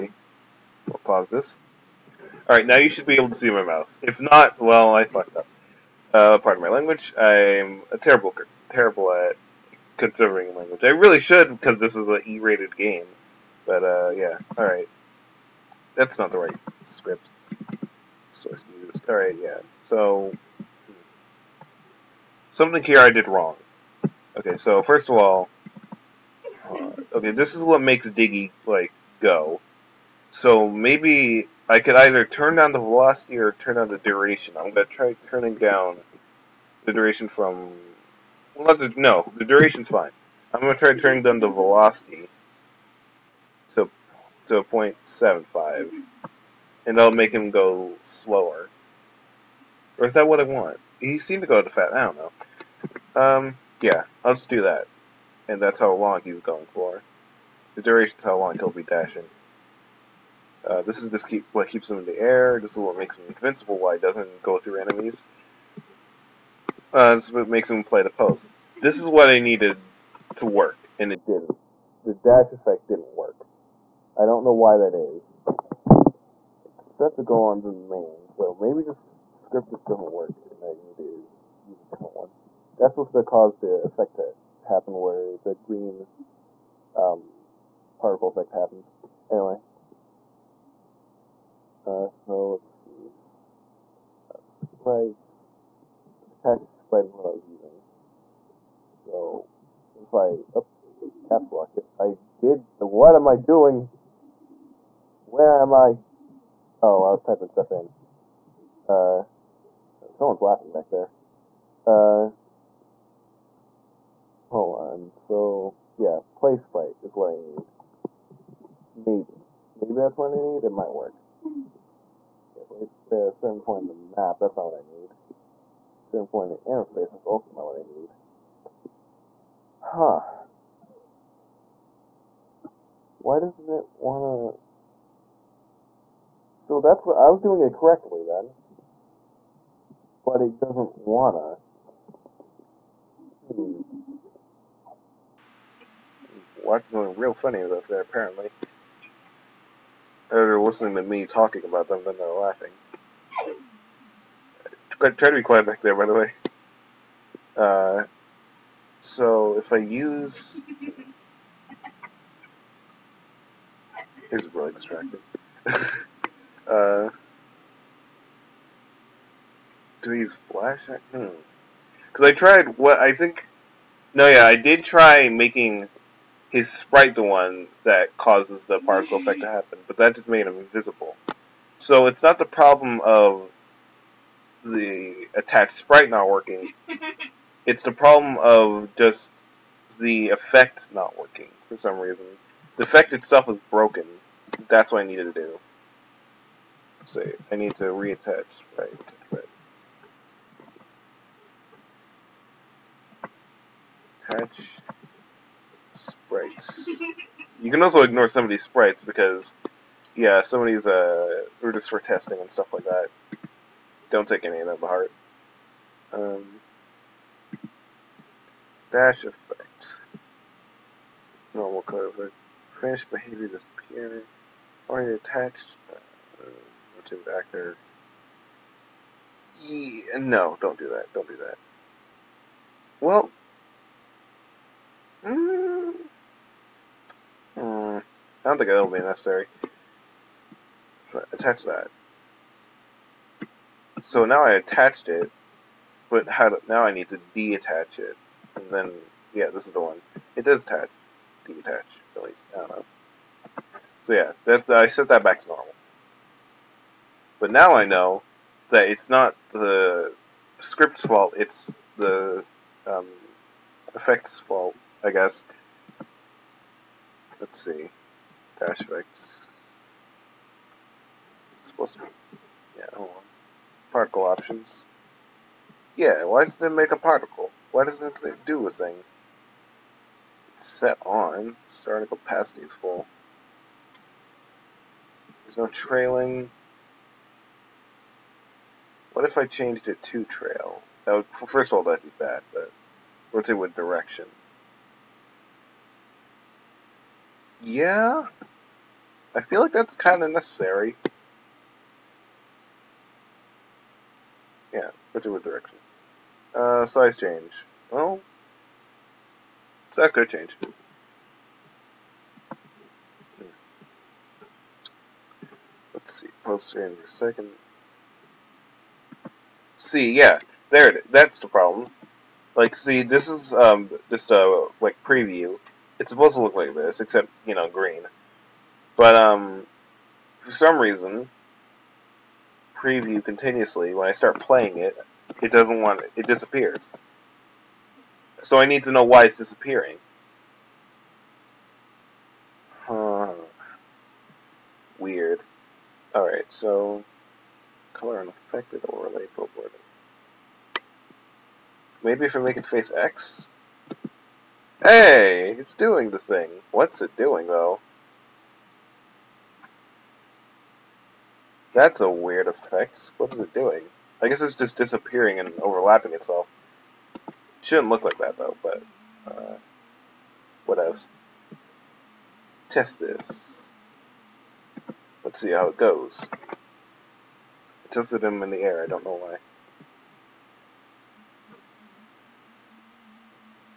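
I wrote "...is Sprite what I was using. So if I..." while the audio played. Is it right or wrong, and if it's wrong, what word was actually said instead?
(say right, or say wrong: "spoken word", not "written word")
right.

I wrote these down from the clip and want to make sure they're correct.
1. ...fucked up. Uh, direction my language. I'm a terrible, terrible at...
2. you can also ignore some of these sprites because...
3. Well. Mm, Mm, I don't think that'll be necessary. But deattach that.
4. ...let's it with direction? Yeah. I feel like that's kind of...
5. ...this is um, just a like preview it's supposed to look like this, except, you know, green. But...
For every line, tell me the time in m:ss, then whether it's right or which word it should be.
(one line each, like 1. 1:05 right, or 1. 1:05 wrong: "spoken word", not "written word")
1. 0:05 wrong: "pardon", not "direction"
2. 3:27 right
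3. 3:53 wrong: "attach", not "deattach"
4. 4:53 right
5. 5:23 right.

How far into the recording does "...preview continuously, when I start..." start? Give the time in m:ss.
5:32.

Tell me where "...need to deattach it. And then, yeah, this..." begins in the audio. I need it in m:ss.
4:06.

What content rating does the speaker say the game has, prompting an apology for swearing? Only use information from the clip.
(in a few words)
E-rated.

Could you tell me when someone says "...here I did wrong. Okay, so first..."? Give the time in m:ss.
0:22.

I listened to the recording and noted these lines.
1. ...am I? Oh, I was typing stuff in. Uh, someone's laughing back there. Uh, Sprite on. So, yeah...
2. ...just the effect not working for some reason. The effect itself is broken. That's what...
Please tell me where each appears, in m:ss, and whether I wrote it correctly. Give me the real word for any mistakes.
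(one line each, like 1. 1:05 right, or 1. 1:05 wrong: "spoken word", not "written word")
1. 1:45 wrong: "Hold", not "Sprite"
2. 3:08 right.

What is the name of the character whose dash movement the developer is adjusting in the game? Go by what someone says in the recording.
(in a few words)
Diggy.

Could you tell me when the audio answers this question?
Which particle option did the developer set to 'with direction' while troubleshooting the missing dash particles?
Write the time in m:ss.
4:50.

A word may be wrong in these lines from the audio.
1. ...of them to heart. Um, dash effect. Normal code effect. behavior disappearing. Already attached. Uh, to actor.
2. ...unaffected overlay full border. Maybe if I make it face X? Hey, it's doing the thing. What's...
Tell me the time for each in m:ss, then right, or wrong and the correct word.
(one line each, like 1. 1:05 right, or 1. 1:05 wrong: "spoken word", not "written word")
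1. 3:34 right
2. 5:48 right.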